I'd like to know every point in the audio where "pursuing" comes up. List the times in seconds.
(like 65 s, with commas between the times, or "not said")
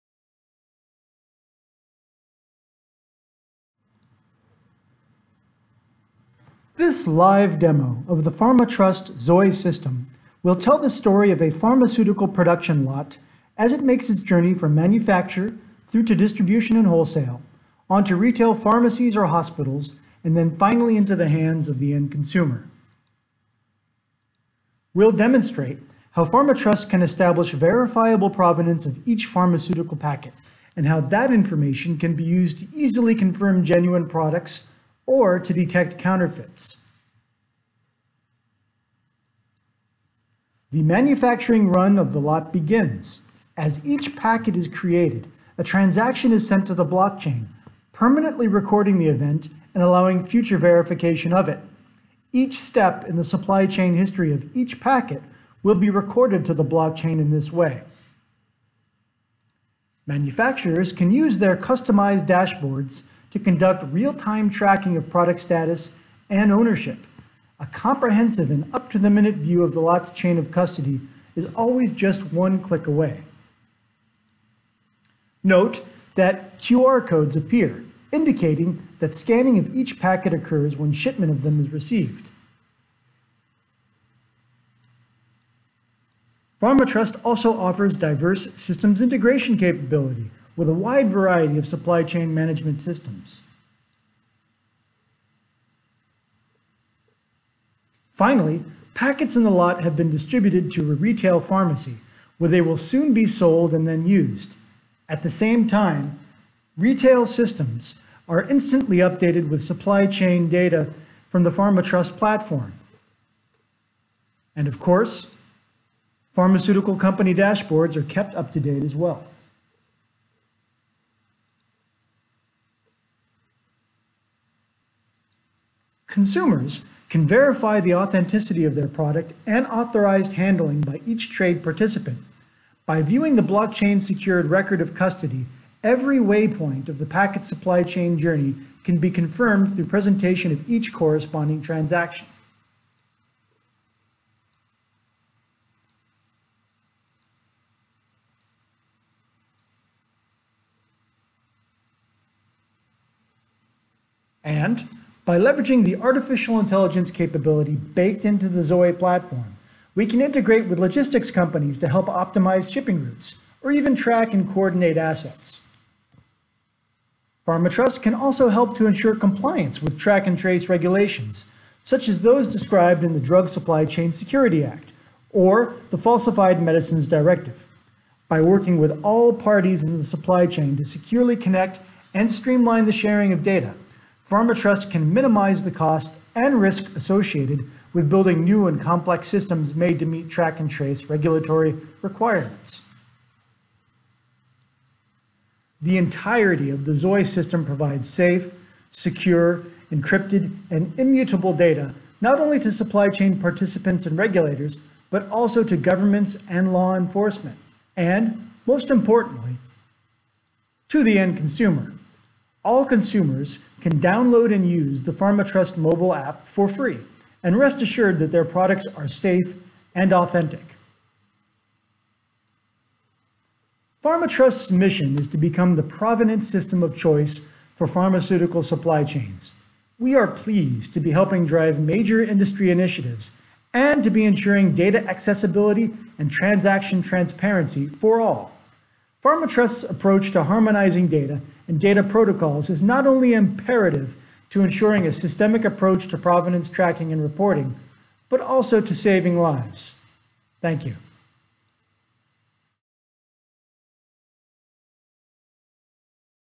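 not said.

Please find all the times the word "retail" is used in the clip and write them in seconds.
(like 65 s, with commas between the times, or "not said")
18 s, 100 s, 106 s.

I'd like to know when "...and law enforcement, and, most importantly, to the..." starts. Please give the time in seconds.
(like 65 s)
206 s.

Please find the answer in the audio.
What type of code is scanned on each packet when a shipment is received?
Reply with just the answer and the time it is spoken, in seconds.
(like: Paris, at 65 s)
QR codes, at 76 s.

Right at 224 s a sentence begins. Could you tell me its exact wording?
FarmaTrust's mission is to become the provenance system of choice for pharmaceutical supply chains.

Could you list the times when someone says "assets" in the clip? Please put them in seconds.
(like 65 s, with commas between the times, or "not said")
164 s.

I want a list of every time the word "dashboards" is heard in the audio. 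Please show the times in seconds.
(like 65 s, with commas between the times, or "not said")
62 s, 117 s.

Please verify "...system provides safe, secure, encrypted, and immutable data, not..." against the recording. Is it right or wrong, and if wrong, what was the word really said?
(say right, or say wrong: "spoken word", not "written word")
right.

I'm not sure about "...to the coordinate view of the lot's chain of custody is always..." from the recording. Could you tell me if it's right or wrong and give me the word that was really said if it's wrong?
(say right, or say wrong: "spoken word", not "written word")
wrong: "minute", not "coordinate".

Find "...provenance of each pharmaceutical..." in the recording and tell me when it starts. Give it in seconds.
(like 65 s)
28 s.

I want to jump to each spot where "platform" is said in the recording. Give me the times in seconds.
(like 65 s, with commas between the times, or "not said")
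112 s, 158 s.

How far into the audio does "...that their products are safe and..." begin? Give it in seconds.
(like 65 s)
218 s.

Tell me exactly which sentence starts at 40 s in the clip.
The manufacturing run of the lot begins.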